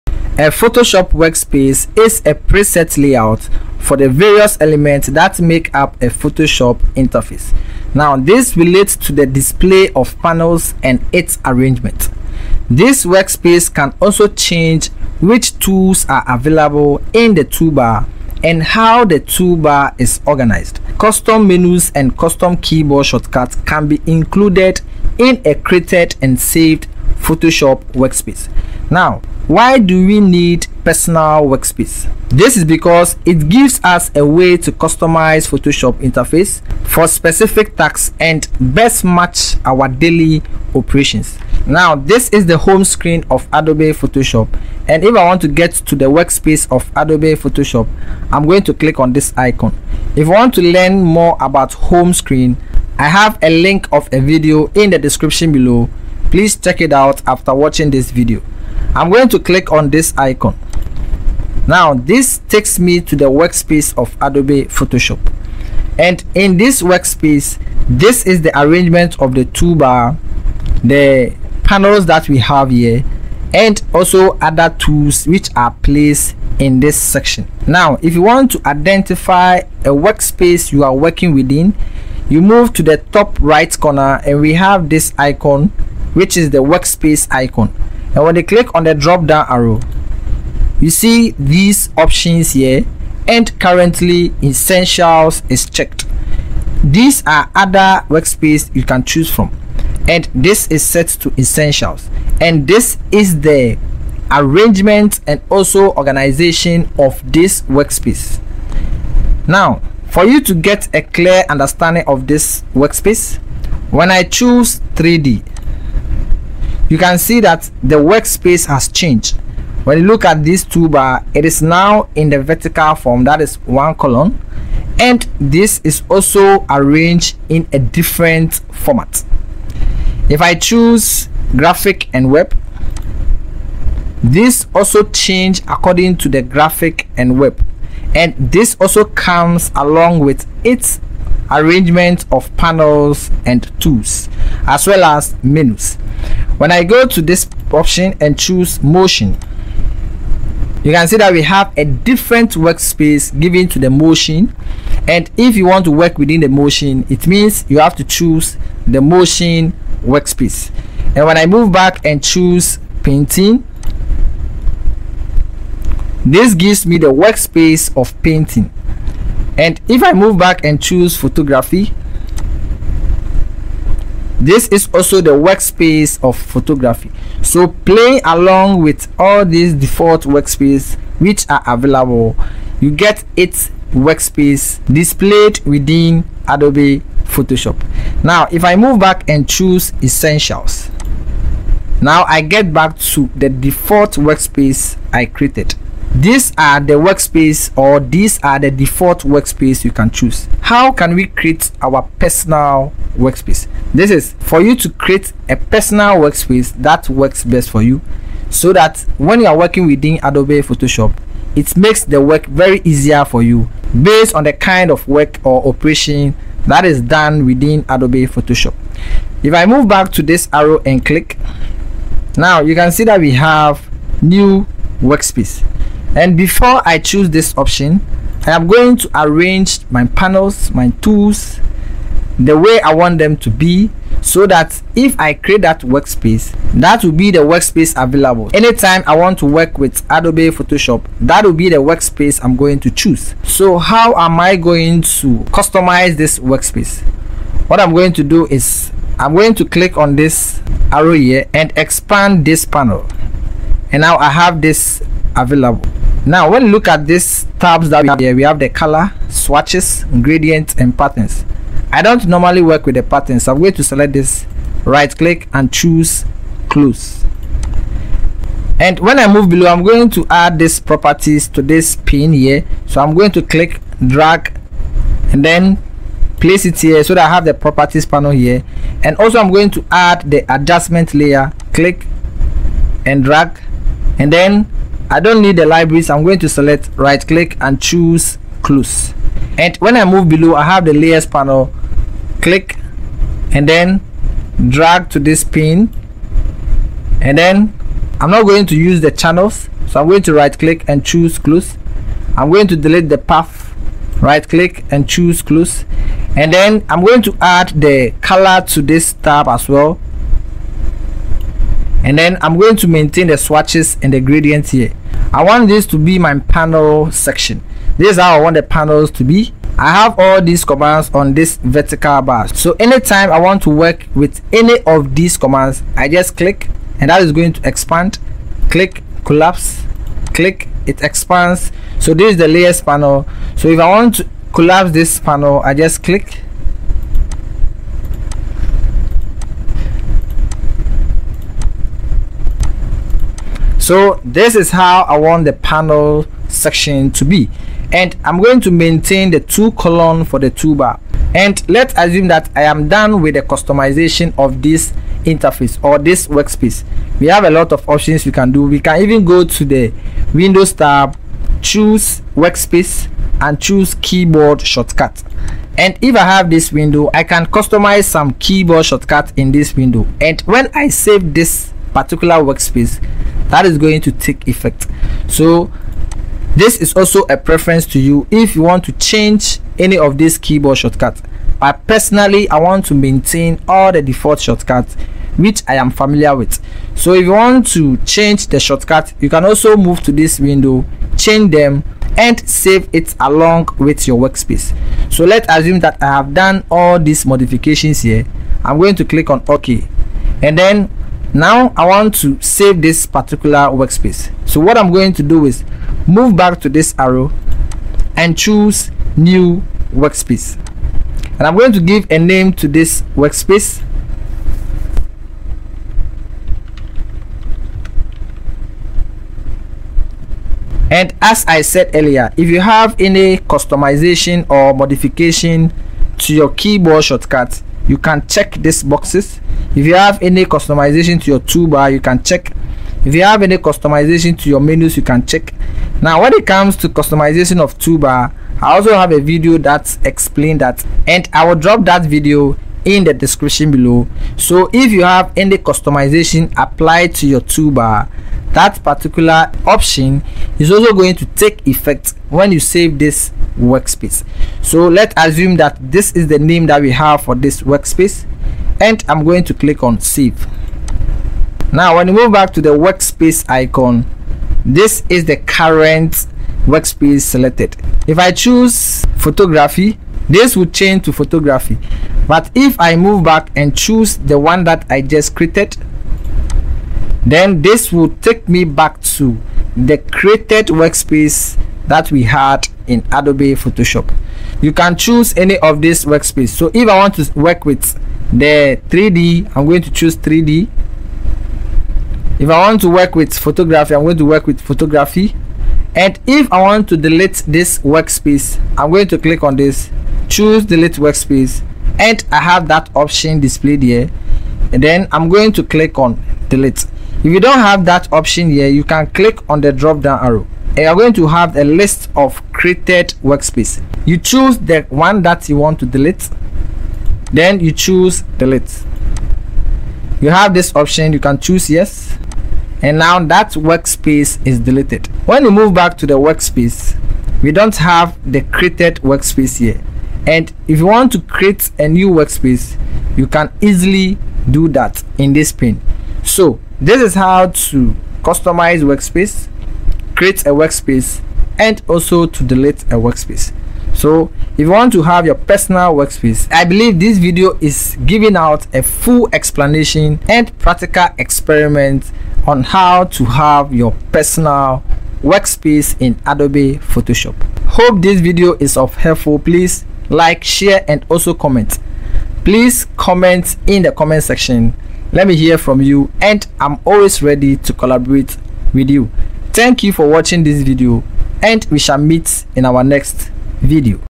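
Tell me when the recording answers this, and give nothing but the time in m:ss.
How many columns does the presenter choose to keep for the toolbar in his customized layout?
5:49.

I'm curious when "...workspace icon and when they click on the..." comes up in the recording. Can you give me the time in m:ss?
1:26.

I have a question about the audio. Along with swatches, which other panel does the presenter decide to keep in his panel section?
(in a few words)
Gradients.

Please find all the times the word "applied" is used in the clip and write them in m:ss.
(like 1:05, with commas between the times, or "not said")
7:26.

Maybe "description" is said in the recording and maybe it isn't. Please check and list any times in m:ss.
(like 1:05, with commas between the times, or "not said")
0:54, 7:23.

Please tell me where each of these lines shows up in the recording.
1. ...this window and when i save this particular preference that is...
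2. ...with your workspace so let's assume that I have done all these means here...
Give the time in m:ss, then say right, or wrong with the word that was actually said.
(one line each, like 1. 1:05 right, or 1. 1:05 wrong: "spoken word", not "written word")
1. 6:09 wrong: "workspace", not "preference"
2. 6:33 wrong: "modifications", not "means".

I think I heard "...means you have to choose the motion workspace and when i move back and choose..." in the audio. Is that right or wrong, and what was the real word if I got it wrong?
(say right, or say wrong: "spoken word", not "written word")
right.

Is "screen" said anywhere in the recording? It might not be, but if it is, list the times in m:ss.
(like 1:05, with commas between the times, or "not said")
0:42, 0:52.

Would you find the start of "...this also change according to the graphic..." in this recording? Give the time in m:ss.
2:14.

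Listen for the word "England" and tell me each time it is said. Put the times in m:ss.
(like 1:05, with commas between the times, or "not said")
not said.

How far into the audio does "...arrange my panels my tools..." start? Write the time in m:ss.
3:49.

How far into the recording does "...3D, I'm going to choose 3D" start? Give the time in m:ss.
8:08.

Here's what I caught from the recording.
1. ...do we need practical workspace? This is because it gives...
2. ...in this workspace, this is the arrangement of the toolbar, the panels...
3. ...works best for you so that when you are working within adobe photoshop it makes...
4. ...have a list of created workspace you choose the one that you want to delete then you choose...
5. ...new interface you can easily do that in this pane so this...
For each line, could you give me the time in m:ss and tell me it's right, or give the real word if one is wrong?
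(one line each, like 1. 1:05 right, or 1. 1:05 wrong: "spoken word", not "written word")
1. 0:29 wrong: "personal", not "practical"
2. 1:06 right
3. 3:27 right
4. 8:31 right
5. 8:51 wrong: "workspace", not "interface".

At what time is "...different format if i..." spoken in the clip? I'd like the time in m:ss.
2:07.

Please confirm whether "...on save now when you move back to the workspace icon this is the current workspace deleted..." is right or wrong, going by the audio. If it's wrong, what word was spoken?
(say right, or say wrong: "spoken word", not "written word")
wrong: "selected", not "deleted".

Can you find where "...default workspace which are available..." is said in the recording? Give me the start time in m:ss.
2:59.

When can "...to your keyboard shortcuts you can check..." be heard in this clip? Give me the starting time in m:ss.
7:06.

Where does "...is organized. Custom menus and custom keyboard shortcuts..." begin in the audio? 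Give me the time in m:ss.
0:20.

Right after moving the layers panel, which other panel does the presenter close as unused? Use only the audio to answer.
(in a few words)
Channels.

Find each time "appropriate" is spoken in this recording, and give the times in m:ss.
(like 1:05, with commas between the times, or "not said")
not said.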